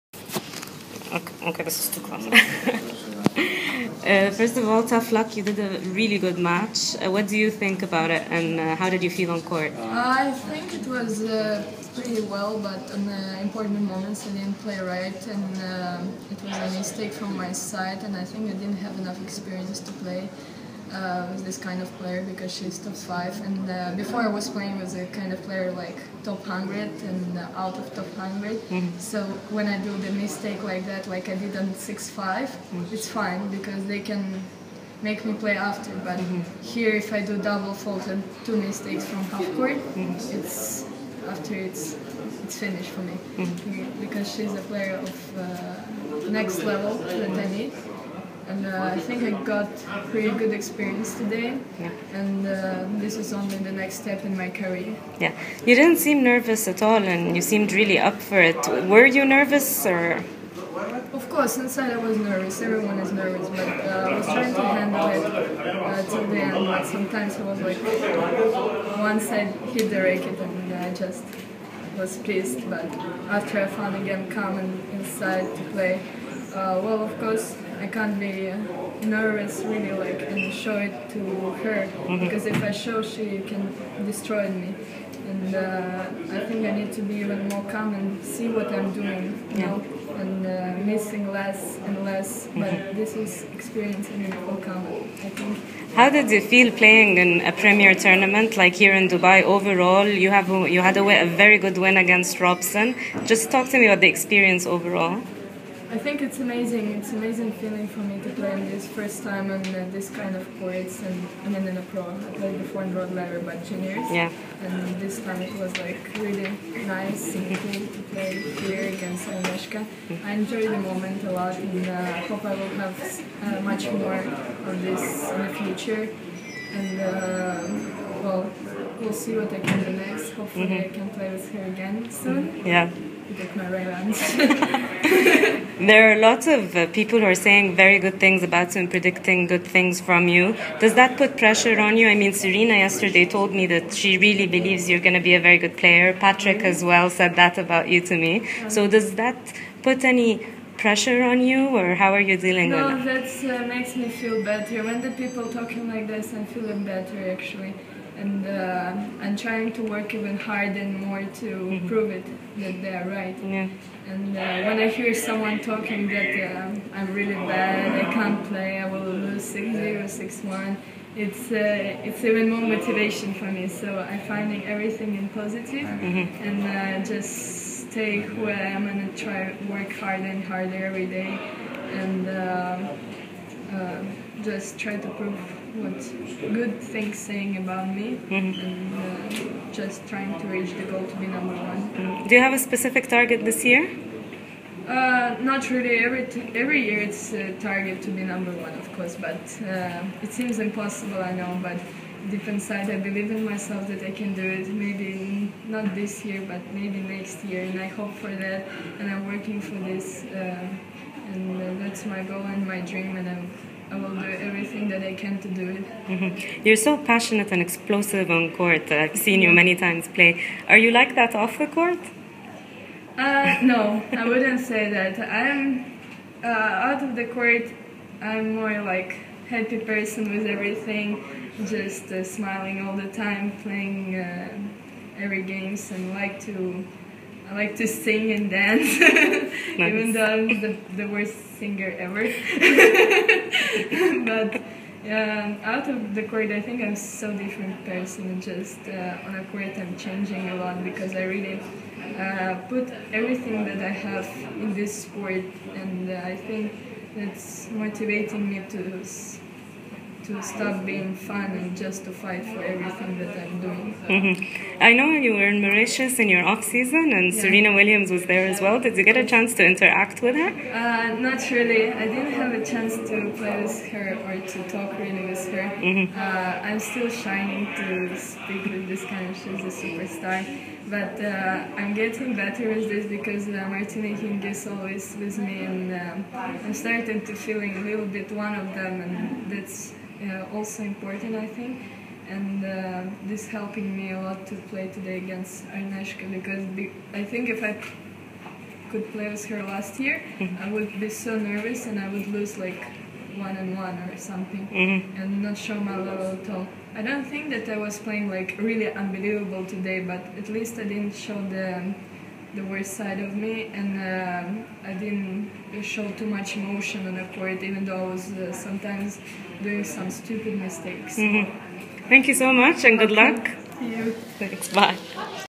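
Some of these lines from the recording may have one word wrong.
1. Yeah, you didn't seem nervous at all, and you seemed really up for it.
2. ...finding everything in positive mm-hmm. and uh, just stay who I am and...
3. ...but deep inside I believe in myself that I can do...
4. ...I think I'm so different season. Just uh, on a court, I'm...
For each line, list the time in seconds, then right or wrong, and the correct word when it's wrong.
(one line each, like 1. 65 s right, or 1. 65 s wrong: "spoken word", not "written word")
1. 55 s right
2. 174 s right
3. 201 s right
4. 246 s wrong: "person", not "season".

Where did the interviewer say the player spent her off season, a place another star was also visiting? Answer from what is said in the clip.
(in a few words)
Mauritius.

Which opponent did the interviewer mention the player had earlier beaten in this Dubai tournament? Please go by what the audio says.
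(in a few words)
Robson.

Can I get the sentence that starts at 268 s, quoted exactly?
Did you get a chance to interact with her?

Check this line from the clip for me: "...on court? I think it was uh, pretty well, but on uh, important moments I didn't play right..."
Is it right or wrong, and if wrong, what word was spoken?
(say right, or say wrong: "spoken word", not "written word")
right.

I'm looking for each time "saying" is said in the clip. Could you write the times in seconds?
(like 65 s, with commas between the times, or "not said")
137 s, 187 s.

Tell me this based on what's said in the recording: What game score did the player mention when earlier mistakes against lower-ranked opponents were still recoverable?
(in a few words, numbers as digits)
6-5.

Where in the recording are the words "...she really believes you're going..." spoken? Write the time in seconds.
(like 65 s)
143 s.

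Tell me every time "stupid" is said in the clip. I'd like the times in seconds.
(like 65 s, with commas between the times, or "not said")
320 s.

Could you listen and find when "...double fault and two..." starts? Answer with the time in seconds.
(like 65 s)
37 s.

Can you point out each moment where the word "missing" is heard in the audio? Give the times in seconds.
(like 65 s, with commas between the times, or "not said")
90 s.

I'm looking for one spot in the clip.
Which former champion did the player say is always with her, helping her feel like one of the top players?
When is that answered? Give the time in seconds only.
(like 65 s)
283 s.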